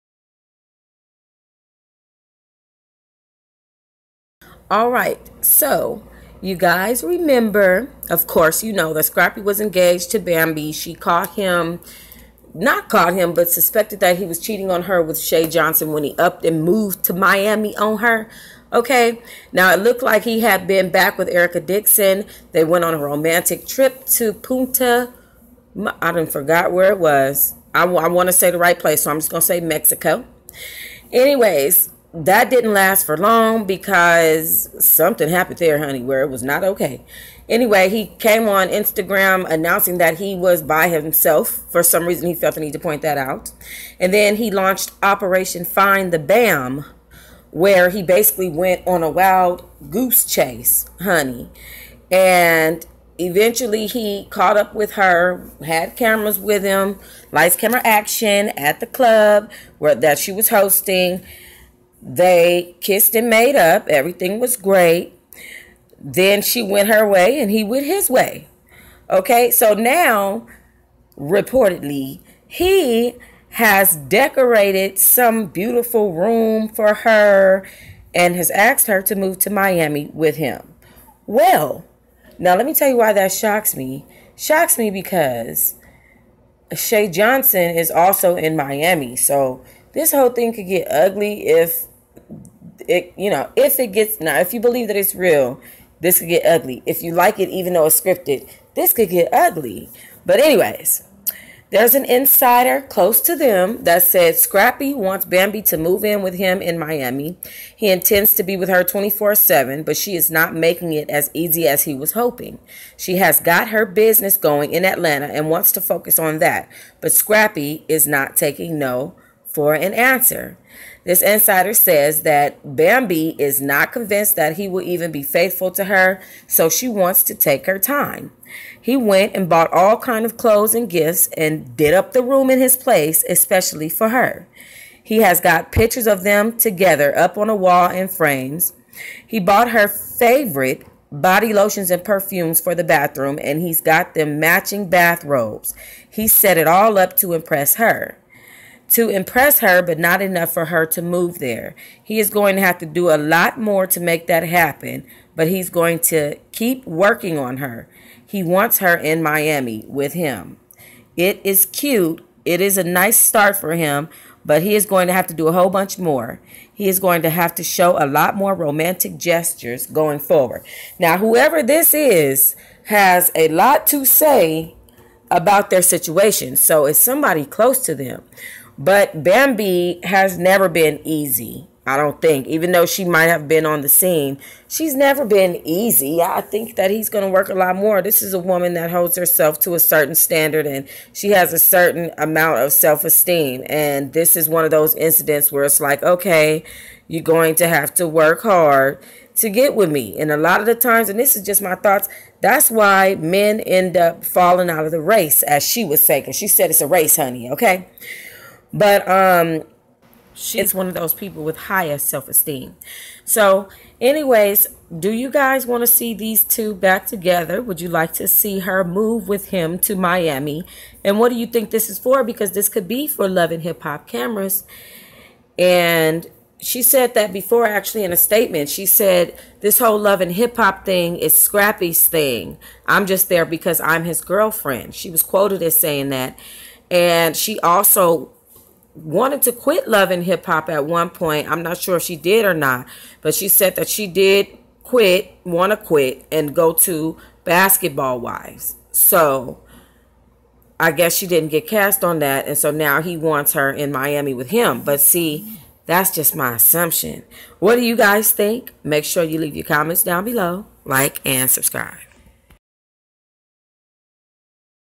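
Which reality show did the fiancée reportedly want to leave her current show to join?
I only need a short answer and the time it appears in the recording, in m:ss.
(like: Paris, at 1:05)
Basketball Wives, at 4:07.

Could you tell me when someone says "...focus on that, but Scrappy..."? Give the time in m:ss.
1:55.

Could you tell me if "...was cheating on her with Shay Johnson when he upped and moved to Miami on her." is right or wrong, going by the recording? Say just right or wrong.
right.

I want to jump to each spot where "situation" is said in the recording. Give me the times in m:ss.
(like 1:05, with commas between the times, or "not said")
2:55.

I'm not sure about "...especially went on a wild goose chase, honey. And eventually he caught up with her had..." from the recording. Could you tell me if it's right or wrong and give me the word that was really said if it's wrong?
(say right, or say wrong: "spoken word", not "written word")
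wrong: "basically", not "especially".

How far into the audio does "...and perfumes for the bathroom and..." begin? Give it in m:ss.
2:21.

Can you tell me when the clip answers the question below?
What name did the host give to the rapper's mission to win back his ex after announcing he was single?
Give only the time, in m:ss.
0:45.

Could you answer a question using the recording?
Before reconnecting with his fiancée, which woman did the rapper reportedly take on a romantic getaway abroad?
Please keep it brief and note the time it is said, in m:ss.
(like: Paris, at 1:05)
Erica Dixon, at 0:21.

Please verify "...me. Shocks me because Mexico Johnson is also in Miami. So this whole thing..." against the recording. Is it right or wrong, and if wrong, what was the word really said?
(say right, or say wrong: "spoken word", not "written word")
wrong: "Shay", not "Mexico".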